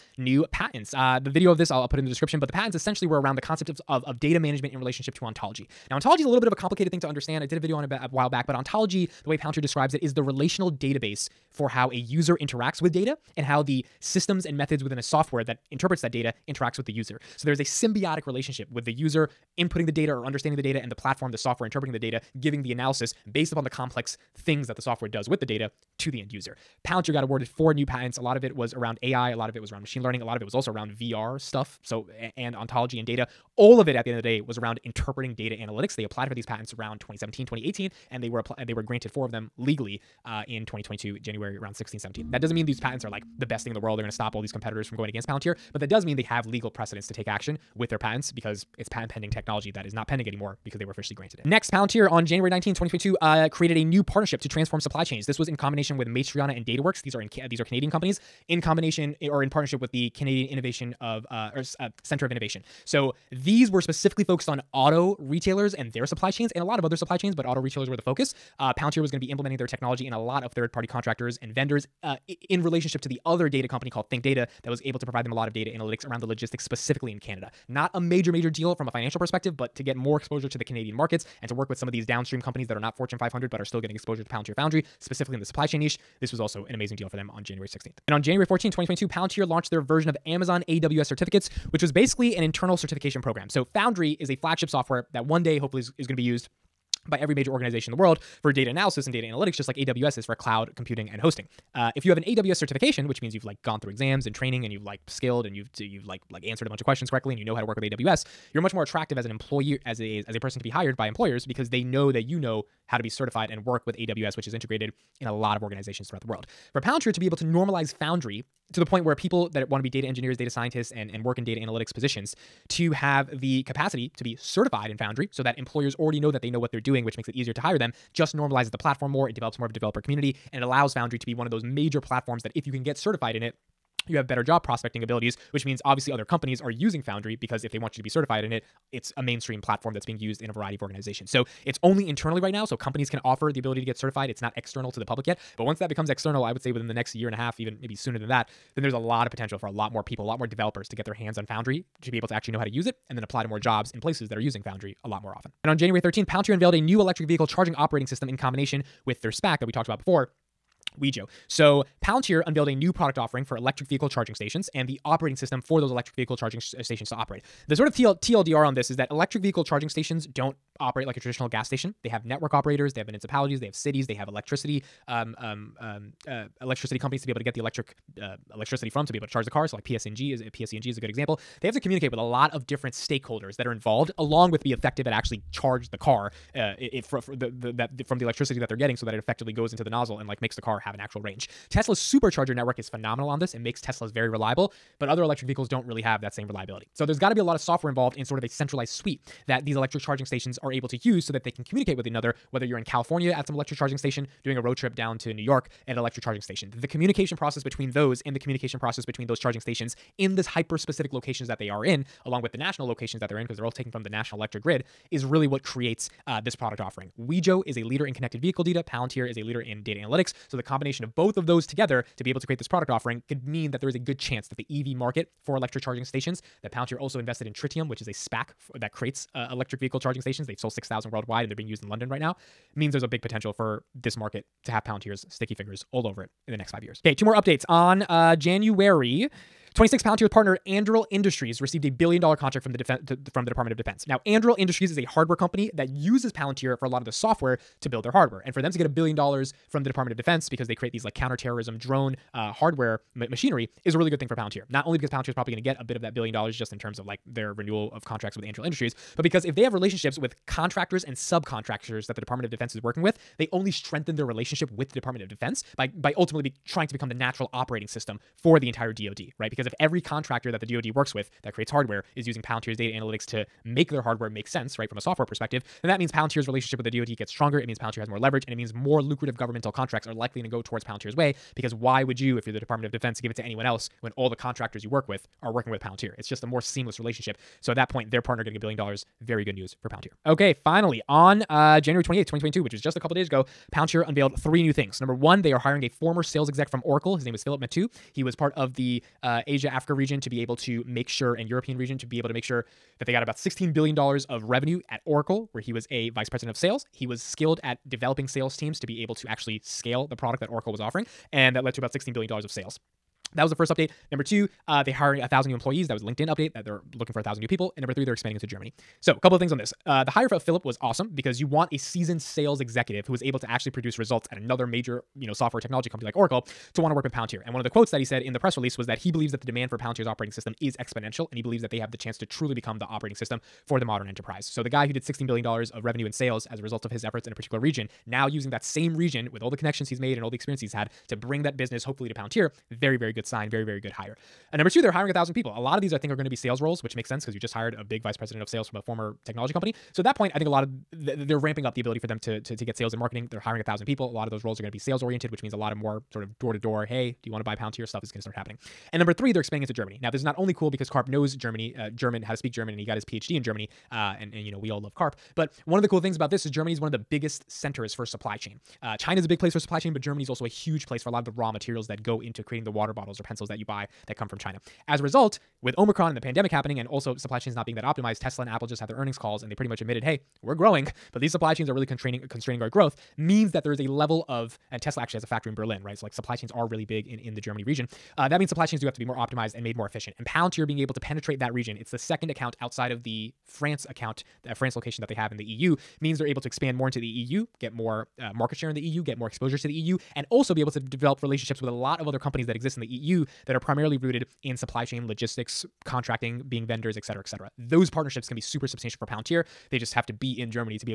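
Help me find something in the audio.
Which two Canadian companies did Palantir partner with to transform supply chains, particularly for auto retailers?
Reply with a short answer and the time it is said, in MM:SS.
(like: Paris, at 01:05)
Matriana and DataWorks, at 00:56.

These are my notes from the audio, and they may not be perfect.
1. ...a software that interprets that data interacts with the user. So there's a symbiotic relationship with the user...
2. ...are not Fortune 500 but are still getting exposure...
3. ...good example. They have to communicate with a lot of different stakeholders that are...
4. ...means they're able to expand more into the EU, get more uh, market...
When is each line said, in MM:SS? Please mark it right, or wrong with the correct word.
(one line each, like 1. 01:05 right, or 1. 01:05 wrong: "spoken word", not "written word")
1. 00:14 right
2. 01:22 right
3. 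03:01 right
4. 06:35 right.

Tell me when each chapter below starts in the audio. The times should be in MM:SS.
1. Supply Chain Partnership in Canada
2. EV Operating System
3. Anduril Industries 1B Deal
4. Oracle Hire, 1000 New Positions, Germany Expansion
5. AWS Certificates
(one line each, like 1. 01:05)
1. 00:51
2. 02:35
3. 03:59
4. 04:53
5. 01:28.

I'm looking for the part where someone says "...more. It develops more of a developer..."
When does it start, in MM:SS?
02:09.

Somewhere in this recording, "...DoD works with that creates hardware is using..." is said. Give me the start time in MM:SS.
04:30.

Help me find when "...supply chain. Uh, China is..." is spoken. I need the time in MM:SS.
06:08.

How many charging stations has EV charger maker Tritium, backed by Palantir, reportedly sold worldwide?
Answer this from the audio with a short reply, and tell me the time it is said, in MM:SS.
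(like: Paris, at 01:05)
6,000, at 03:50.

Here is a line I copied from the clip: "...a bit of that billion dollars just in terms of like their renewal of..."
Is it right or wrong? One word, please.
right.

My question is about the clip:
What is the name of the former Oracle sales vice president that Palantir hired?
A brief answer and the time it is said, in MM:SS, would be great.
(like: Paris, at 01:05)
Philip Matu, at 04:57.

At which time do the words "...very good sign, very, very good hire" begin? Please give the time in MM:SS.
05:42.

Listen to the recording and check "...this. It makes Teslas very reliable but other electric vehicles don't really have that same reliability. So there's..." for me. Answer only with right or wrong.
right.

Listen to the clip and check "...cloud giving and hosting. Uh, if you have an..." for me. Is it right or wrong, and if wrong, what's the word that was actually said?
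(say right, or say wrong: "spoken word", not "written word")
wrong: "computing", not "giving".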